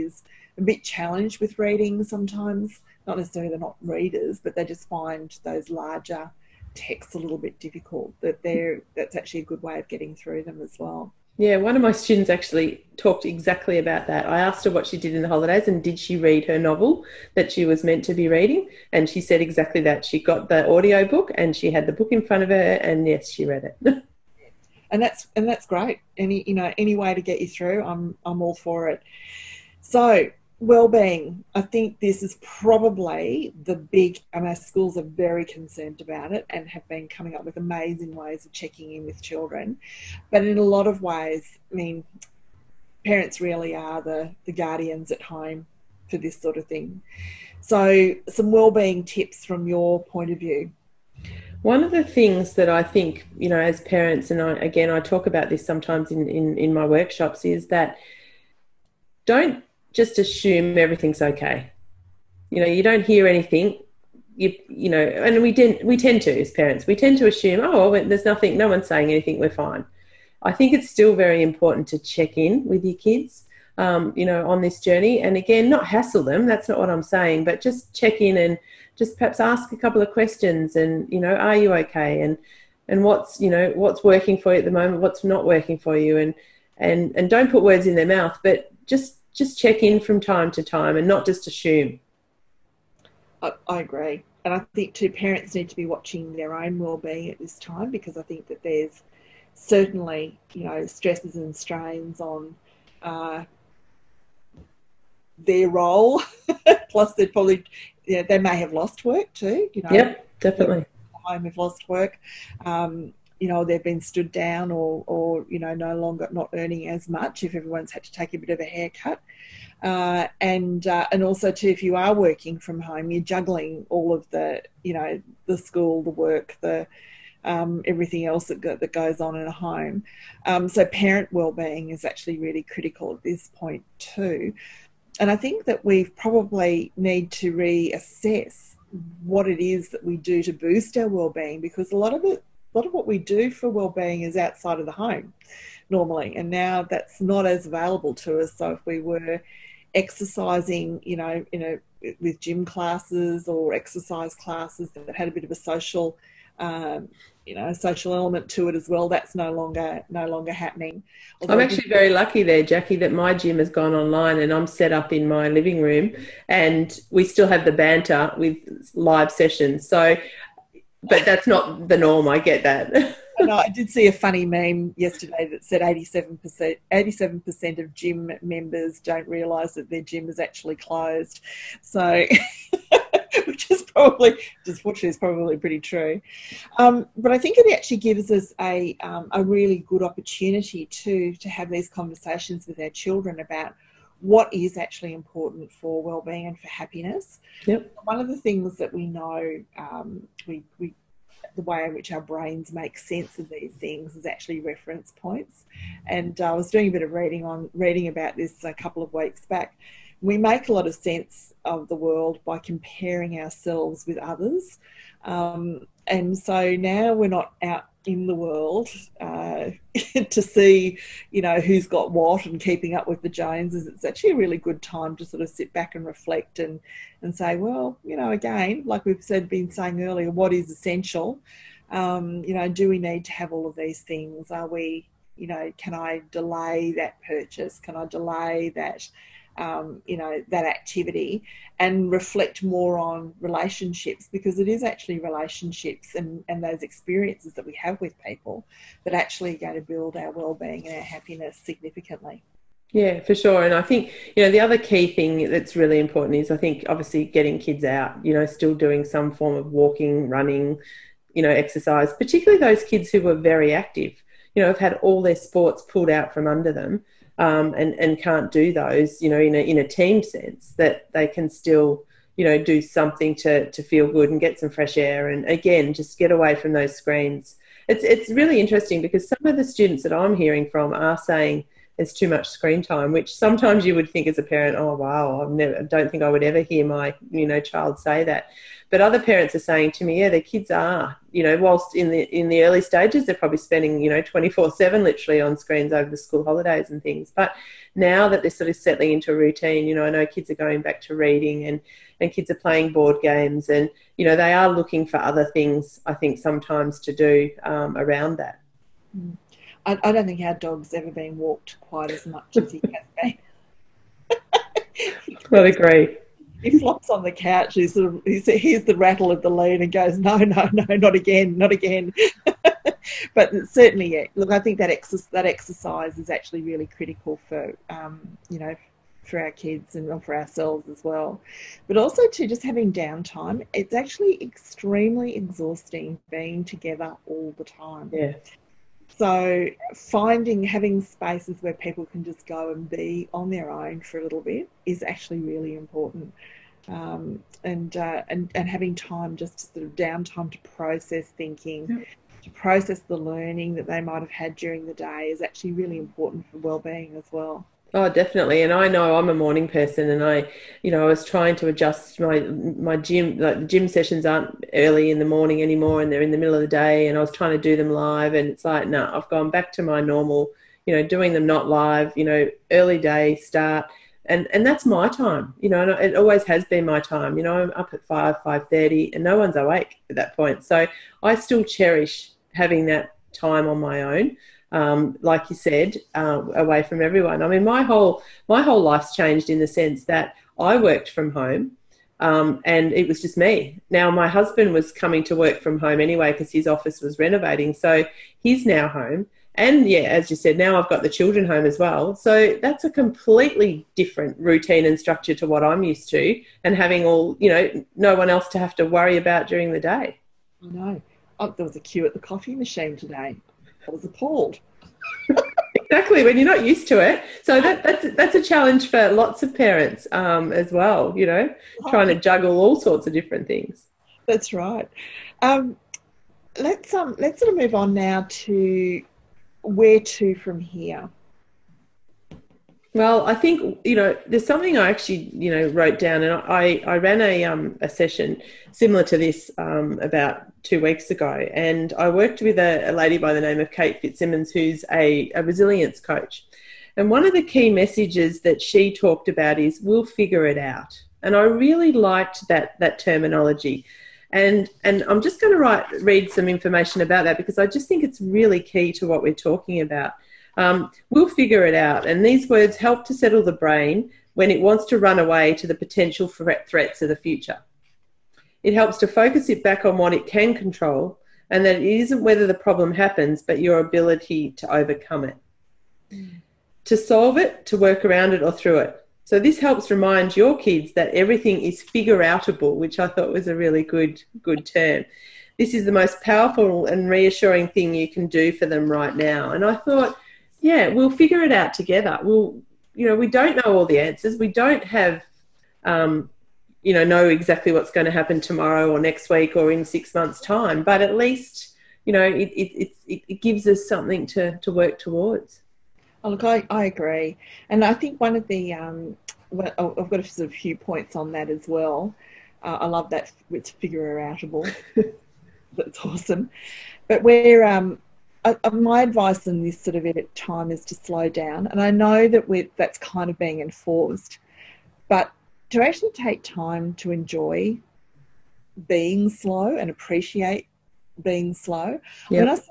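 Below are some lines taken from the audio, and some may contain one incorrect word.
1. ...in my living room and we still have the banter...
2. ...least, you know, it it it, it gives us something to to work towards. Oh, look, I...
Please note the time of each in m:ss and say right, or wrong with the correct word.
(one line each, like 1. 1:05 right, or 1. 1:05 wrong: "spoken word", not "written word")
1. 2:45 right
2. 8:21 right.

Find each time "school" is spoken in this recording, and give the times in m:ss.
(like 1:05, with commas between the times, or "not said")
0:34, 2:05, 4:56.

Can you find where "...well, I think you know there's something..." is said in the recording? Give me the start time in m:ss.
7:12.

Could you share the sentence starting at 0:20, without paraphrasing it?
She got the audio book and she had the book in front of her and yes, she read it.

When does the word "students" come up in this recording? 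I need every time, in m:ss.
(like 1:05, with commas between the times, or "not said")
0:11, 4:39.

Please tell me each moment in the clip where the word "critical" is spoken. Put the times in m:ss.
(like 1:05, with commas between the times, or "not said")
2:12, 5:26.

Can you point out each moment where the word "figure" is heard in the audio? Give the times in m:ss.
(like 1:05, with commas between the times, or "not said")
7:30, 7:41, 8:01, 8:11, 8:33.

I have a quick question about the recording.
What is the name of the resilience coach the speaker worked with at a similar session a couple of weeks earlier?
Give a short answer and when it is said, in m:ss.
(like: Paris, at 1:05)
Kate Fitzsimmons, at 7:23.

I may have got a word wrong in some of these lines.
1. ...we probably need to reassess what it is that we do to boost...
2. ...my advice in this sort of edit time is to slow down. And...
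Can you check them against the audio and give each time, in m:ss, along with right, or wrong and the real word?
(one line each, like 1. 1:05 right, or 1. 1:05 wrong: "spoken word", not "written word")
1. 2:15 right
2. 8:38 right.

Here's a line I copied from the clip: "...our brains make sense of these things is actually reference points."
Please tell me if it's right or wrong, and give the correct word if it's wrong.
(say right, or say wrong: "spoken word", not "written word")
right.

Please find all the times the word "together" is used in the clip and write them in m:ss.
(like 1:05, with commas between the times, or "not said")
5:36, 8:11.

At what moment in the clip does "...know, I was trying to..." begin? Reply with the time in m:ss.
6:00.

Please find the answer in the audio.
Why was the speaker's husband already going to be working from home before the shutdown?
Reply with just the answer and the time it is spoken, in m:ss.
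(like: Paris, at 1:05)
office was renovating, at 6:36.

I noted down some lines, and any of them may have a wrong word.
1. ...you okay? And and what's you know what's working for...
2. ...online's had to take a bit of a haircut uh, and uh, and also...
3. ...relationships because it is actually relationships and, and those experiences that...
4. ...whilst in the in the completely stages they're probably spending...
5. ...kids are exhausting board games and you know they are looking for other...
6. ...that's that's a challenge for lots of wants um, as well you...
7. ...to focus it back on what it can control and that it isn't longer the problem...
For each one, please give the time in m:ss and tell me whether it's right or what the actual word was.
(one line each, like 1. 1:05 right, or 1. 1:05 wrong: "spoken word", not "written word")
1. 1:21 right
2. 1:57 wrong: "everyone", not "online"
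3. 4:03 right
4. 4:51 wrong: "early", not "completely"
5. 5:02 wrong: "playing", not "exhausting"
6. 6:57 wrong: "parents", not "wants"
7. 7:48 wrong: "whether", not "longer".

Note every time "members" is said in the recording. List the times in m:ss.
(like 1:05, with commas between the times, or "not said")
2:58.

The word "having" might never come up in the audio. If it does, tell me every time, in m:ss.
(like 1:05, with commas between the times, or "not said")
5:32, 5:40, 5:48, 6:22, 6:46.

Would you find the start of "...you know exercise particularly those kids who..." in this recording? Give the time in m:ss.
4:21.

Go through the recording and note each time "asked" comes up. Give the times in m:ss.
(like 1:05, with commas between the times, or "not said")
0:14.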